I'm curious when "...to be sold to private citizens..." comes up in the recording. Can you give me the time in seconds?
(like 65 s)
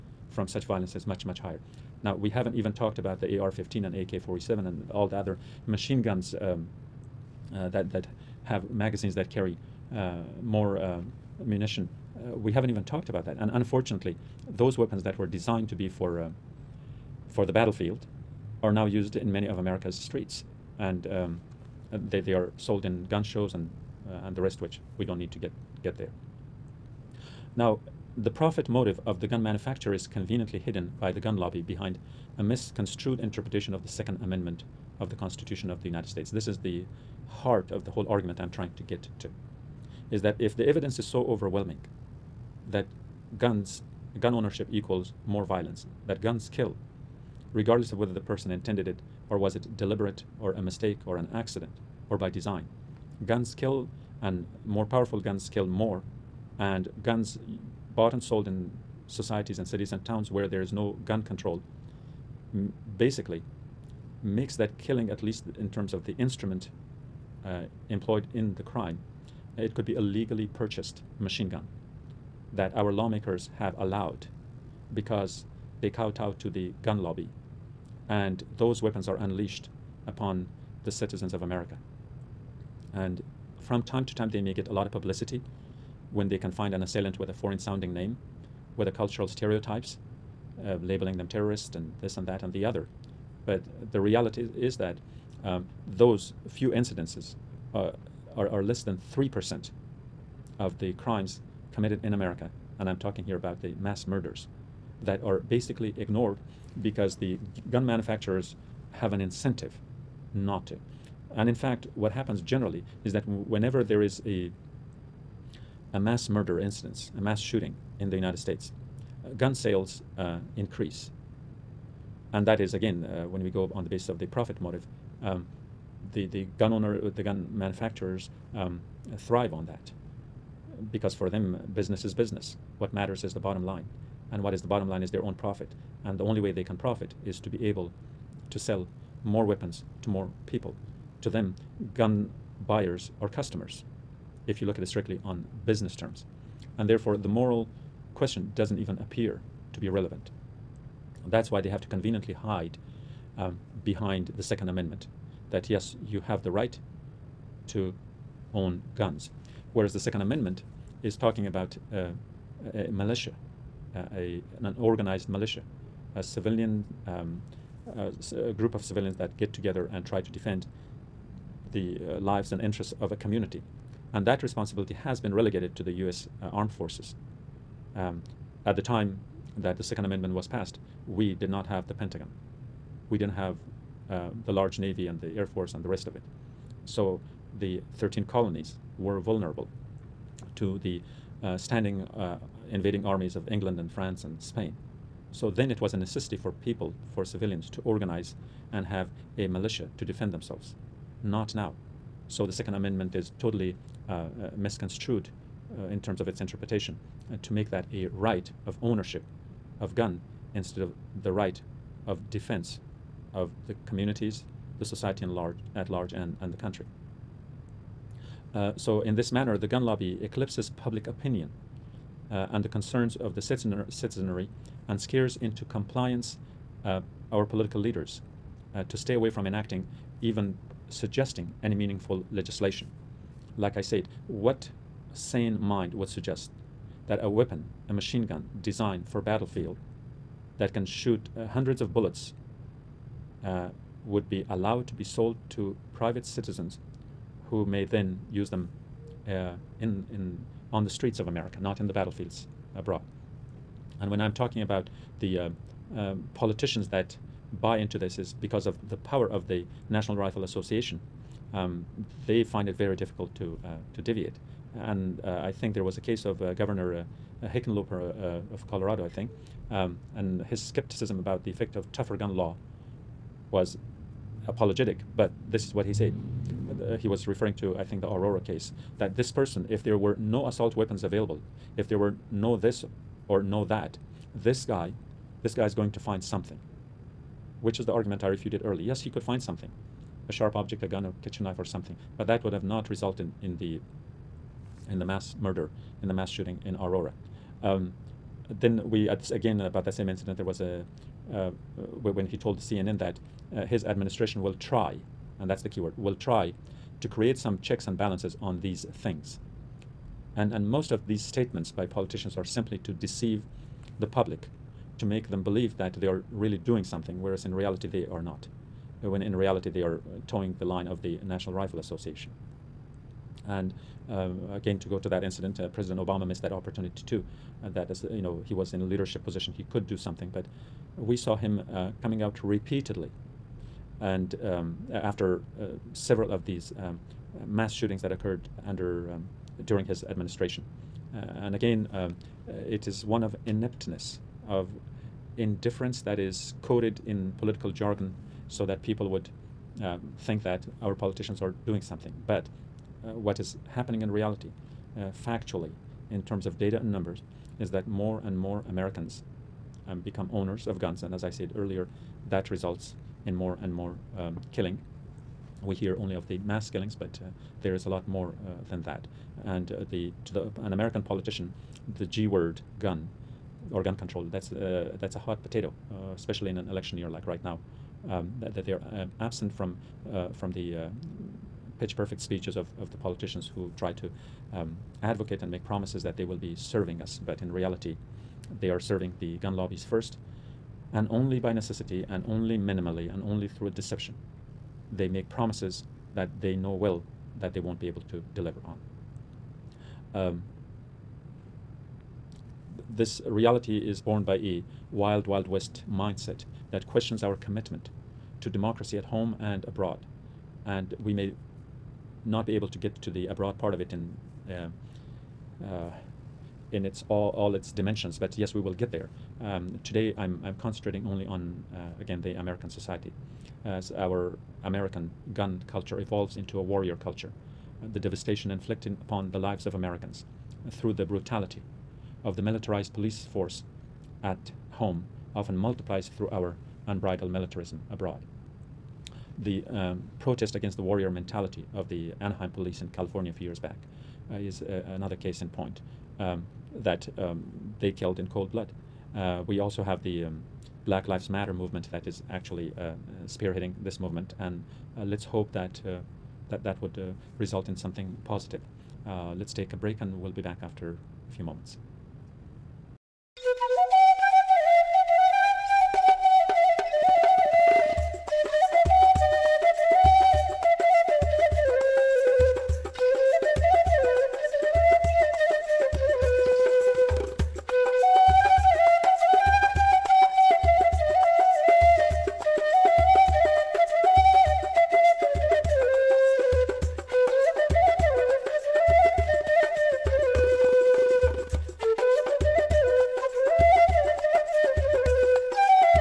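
244 s.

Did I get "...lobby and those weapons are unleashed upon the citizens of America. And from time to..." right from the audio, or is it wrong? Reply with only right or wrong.
right.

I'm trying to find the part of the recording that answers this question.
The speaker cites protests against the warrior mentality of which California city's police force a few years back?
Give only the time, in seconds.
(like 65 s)
442 s.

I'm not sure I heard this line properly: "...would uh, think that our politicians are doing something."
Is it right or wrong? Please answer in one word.
right.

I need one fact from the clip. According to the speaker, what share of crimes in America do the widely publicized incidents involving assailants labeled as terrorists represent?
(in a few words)
less than 3%.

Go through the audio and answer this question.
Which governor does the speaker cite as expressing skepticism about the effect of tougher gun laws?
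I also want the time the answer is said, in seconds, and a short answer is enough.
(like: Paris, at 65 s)
Hickenlooper, at 267 s.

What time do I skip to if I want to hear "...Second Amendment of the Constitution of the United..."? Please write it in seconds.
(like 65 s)
33 s.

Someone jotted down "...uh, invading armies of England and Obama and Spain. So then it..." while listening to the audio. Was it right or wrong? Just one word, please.
wrong.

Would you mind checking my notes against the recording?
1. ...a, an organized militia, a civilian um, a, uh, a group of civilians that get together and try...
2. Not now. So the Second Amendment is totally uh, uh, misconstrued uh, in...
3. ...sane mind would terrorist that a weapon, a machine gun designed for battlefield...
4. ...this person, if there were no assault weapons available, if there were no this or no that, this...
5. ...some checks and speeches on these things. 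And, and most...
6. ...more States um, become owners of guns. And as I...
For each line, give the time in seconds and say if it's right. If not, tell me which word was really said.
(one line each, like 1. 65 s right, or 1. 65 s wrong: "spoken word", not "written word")
1. 164 s right
2. 201 s right
3. 235 s wrong: "suggest", not "terrorist"
4. 279 s right
5. 307 s wrong: "balances", not "speeches"
6. 358 s wrong: "Americans", not "States".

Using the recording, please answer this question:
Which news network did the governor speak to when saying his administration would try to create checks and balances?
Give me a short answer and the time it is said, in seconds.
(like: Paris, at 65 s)
CNN, at 302 s.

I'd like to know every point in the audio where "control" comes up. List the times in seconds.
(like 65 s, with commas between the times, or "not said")
61 s, 373 s.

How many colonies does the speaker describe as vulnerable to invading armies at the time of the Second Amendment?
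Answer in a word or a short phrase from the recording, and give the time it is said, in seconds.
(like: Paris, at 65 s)
13, at 187 s.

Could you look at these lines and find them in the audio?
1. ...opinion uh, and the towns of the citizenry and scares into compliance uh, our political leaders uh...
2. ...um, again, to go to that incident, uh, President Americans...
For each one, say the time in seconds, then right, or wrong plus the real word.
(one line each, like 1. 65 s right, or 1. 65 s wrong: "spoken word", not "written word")
1. 221 s wrong: "concerns", not "towns"
2. 324 s wrong: "Obama", not "Americans".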